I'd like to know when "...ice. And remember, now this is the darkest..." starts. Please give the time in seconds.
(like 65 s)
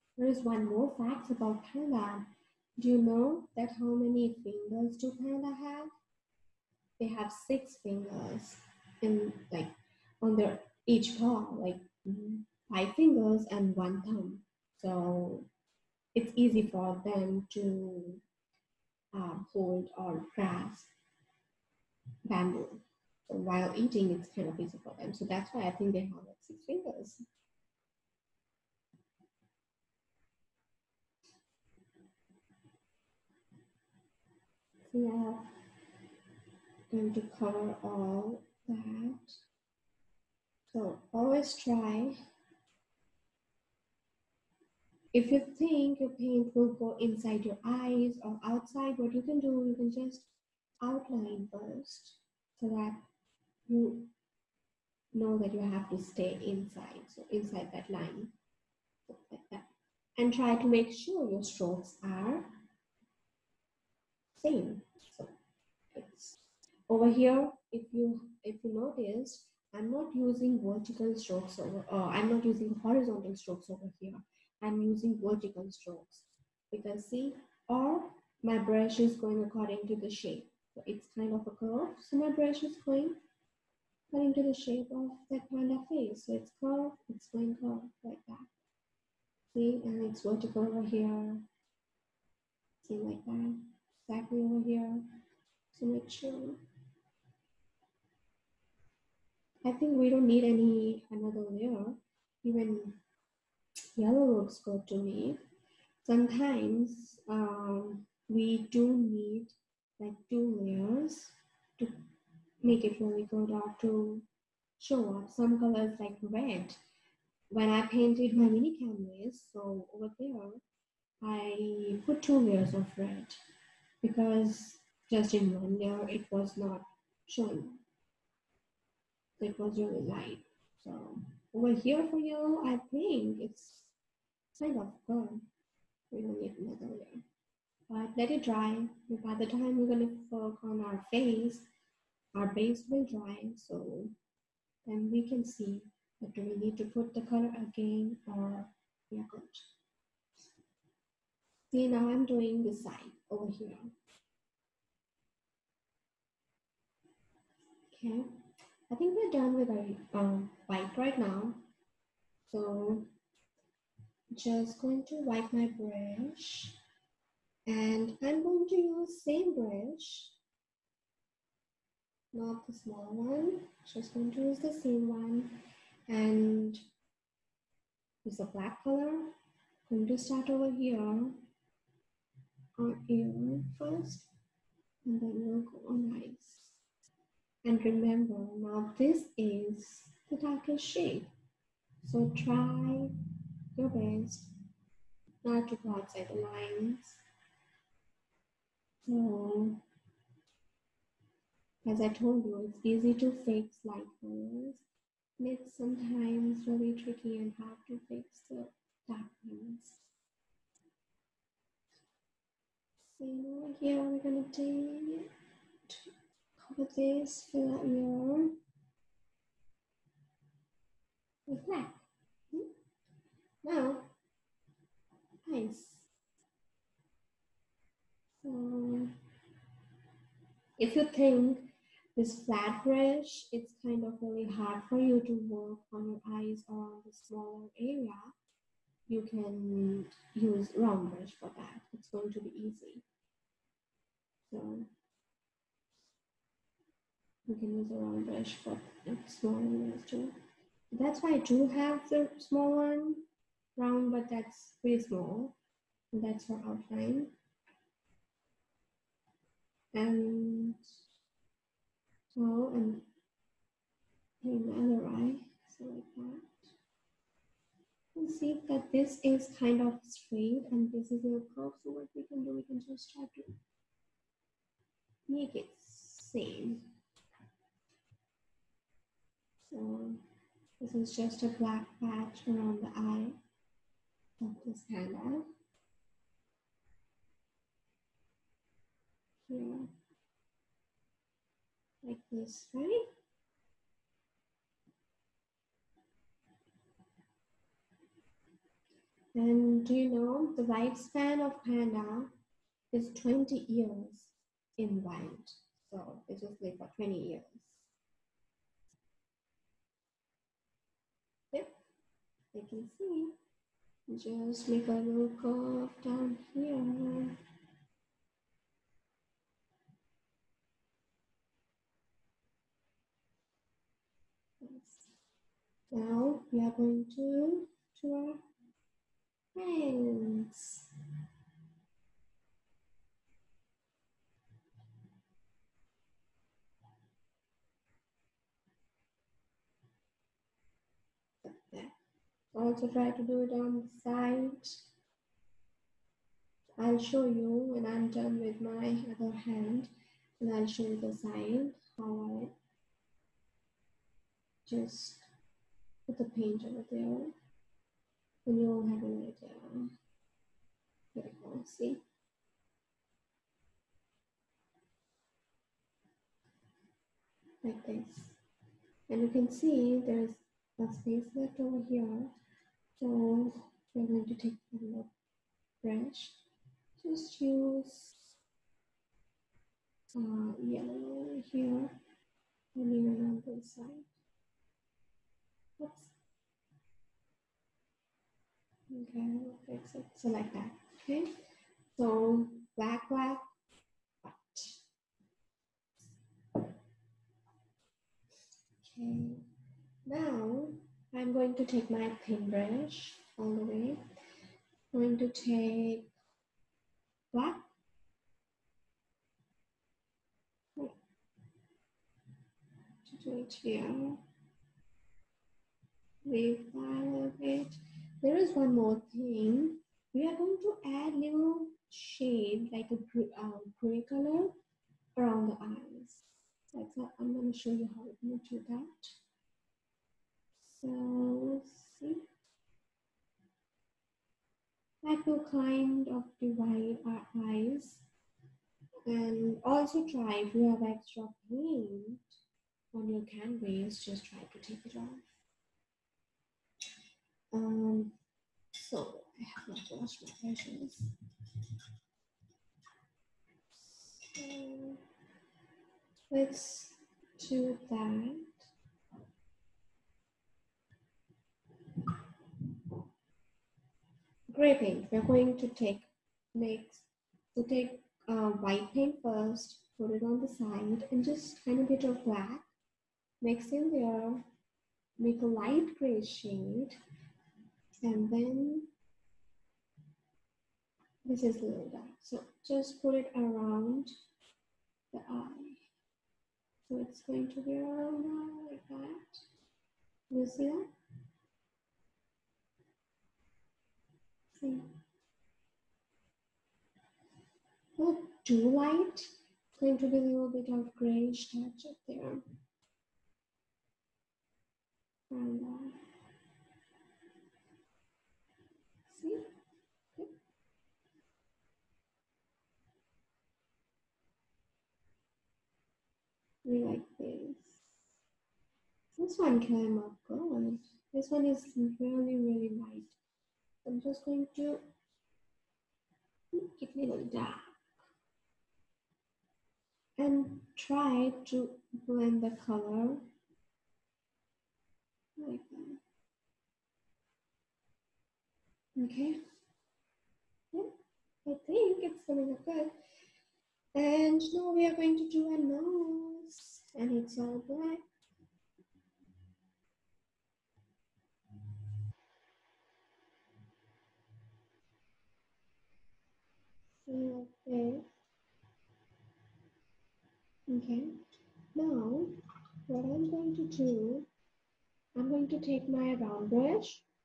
186 s.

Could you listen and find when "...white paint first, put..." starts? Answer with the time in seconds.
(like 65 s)
468 s.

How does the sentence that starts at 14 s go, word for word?
So it's easy for them to uh, hold or grasp bamboo.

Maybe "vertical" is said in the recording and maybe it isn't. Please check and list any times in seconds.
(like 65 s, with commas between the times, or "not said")
70 s, 75 s, 90 s.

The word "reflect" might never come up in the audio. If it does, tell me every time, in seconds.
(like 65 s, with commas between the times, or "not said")
221 s.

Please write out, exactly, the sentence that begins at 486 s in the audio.
So it's going to be around now like that.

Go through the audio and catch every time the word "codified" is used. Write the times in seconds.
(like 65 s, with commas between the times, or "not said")
not said.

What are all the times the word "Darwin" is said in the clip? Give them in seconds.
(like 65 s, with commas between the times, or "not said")
not said.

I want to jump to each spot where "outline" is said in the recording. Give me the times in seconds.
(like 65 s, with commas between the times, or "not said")
50 s, 256 s.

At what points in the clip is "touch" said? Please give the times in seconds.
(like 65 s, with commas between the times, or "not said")
501 s.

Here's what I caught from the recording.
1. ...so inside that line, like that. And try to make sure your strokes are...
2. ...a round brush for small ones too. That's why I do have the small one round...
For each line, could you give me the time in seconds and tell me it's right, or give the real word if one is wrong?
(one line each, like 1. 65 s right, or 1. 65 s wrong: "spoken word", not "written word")
1. 57 s right
2. 247 s right.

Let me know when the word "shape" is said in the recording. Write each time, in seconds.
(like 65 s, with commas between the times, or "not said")
80 s, 84 s.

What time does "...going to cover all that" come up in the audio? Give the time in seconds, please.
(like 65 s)
36 s.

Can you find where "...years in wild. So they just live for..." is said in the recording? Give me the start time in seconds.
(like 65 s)
303 s.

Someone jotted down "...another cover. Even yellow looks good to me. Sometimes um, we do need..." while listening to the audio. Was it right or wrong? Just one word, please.
wrong.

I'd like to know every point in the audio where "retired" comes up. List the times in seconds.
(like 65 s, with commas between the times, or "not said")
not said.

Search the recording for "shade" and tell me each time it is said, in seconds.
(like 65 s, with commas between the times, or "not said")
190 s, 421 s, 476 s.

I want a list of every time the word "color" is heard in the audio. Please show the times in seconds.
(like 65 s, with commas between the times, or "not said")
115 s, 147 s, 178 s, 204 s, 424 s, 532 s.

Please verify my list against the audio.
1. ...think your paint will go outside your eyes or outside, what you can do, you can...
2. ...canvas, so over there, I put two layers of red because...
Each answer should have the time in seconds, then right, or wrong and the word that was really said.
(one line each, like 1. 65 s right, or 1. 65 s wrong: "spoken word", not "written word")
1. 45 s wrong: "inside", not "outside"
2. 118 s right.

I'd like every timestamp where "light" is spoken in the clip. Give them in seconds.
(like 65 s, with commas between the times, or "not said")
130 s, 203 s, 475 s, 498 s, 522 s.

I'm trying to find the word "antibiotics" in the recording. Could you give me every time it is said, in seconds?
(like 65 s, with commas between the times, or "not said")
not said.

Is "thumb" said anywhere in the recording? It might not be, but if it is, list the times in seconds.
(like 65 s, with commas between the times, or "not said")
14 s.